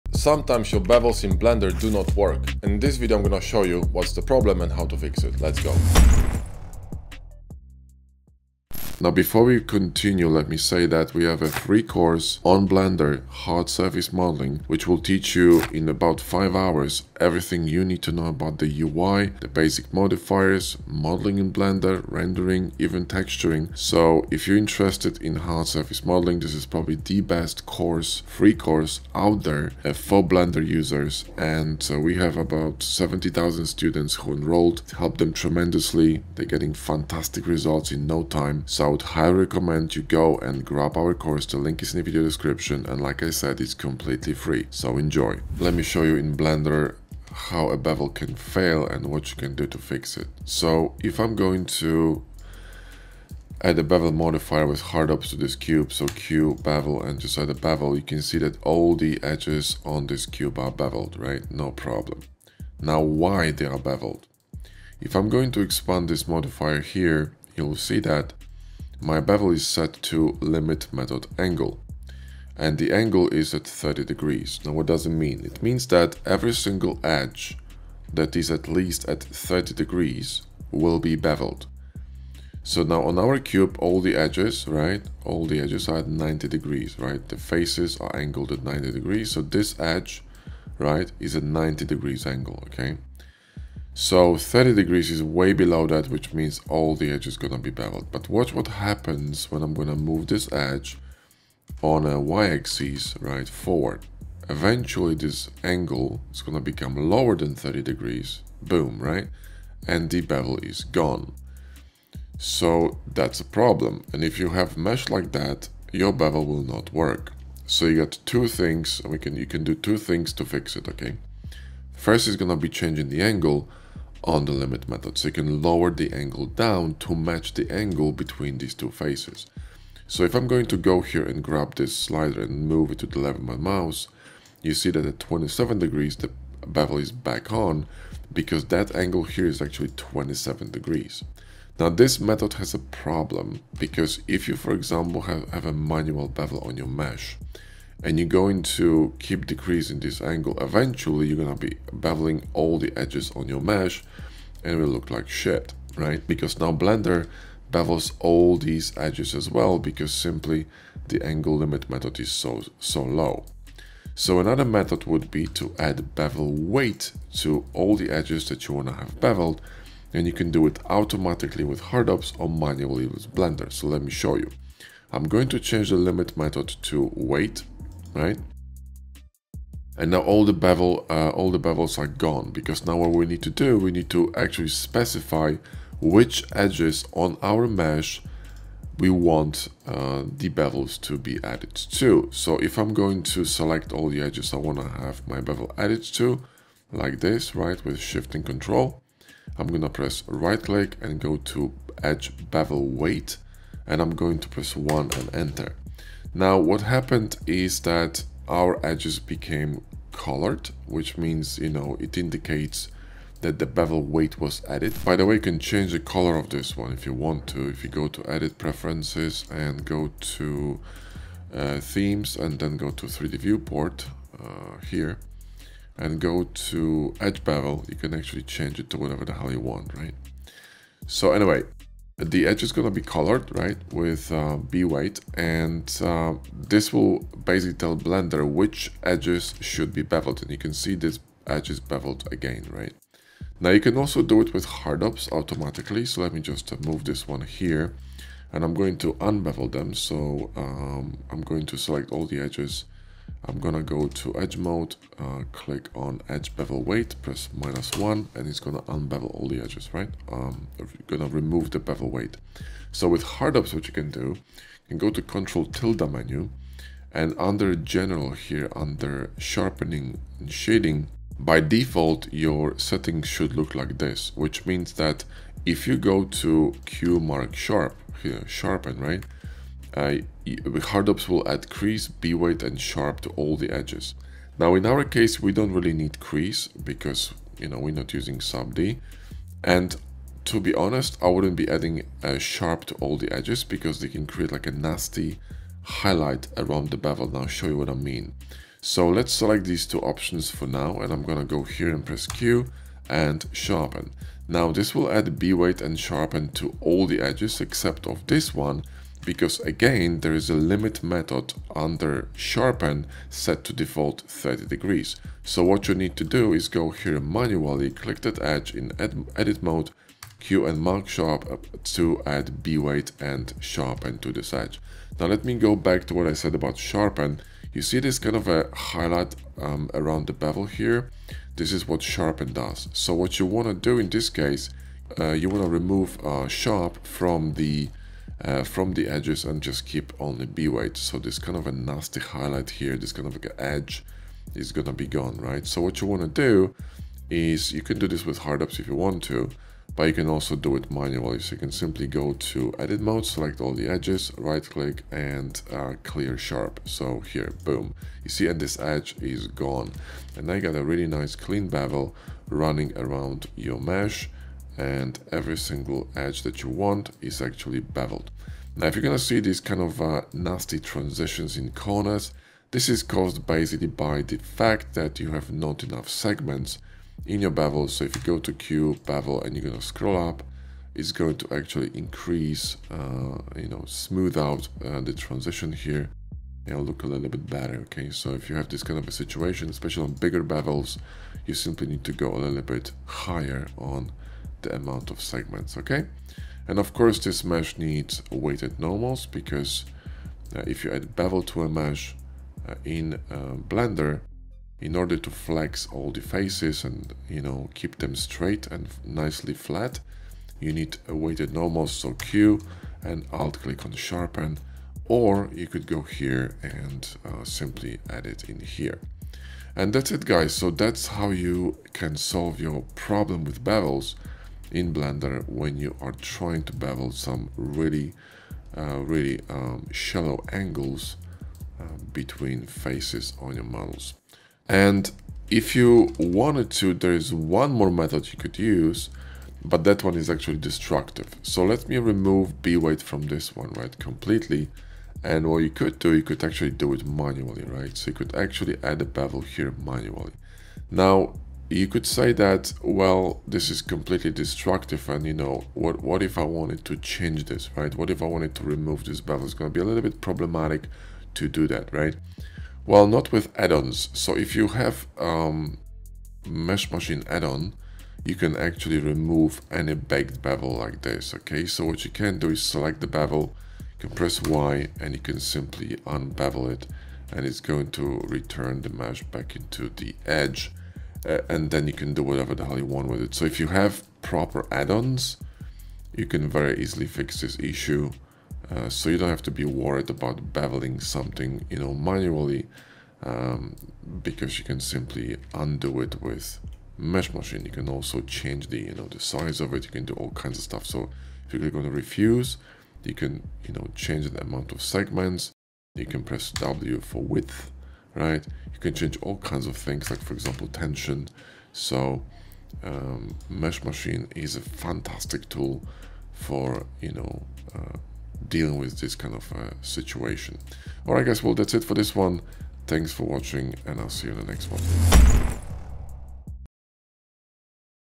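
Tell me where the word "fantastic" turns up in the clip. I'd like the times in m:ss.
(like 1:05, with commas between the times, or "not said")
0:36, 8:34.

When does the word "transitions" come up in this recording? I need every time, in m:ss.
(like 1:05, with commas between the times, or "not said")
6:10, 6:25.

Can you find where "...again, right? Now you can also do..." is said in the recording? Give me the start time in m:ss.
4:02.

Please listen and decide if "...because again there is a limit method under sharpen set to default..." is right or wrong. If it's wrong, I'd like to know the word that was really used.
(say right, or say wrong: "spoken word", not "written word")
right.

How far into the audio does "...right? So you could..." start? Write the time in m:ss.
7:27.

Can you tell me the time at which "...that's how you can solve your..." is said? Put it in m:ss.
7:00.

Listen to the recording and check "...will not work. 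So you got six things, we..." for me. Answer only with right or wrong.
wrong.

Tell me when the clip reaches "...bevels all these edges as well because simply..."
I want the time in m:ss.
2:37.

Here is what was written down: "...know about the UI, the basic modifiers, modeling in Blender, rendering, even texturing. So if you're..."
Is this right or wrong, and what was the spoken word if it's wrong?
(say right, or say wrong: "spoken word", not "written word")
right.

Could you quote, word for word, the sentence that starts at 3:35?
By the way, you can change the color of this one if you want to.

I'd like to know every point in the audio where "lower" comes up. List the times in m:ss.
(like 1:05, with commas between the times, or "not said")
1:47, 2:05.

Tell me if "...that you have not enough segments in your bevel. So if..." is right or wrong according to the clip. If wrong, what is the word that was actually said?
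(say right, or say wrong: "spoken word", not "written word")
right.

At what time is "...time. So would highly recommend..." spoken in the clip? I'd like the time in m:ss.
0:38.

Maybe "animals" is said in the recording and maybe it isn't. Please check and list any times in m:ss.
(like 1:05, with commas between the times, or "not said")
not said.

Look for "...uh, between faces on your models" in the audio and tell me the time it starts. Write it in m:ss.
7:11.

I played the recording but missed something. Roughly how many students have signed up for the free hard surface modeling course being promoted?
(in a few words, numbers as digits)
70,000.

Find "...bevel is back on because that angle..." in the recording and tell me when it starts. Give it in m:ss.
2:16.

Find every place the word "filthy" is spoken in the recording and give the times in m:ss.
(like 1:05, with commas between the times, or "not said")
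not said.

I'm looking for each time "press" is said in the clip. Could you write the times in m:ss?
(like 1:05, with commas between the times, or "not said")
3:19, 3:24, 4:17, 5:02, 7:54, 8:26.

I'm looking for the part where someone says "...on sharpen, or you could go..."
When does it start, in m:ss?
6:53.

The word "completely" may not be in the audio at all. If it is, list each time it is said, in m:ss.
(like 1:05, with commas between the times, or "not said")
0:43, 7:23, 7:33.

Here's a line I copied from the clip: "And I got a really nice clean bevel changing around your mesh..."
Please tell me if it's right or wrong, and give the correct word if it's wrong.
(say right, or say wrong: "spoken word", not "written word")
wrong: "running", not "changing".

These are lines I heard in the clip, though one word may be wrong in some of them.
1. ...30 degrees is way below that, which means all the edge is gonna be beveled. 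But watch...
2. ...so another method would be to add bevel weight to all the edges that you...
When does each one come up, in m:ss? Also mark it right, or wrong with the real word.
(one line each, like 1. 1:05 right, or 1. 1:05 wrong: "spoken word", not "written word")
1. 1:34 right
2. 2:44 right.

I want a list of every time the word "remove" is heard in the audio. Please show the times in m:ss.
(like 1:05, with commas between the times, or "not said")
4:21, 5:35, 7:21, 7:38, 7:48.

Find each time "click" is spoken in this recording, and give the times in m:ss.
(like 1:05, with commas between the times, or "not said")
3:20, 4:15, 5:17, 5:54, 6:53, 8:21.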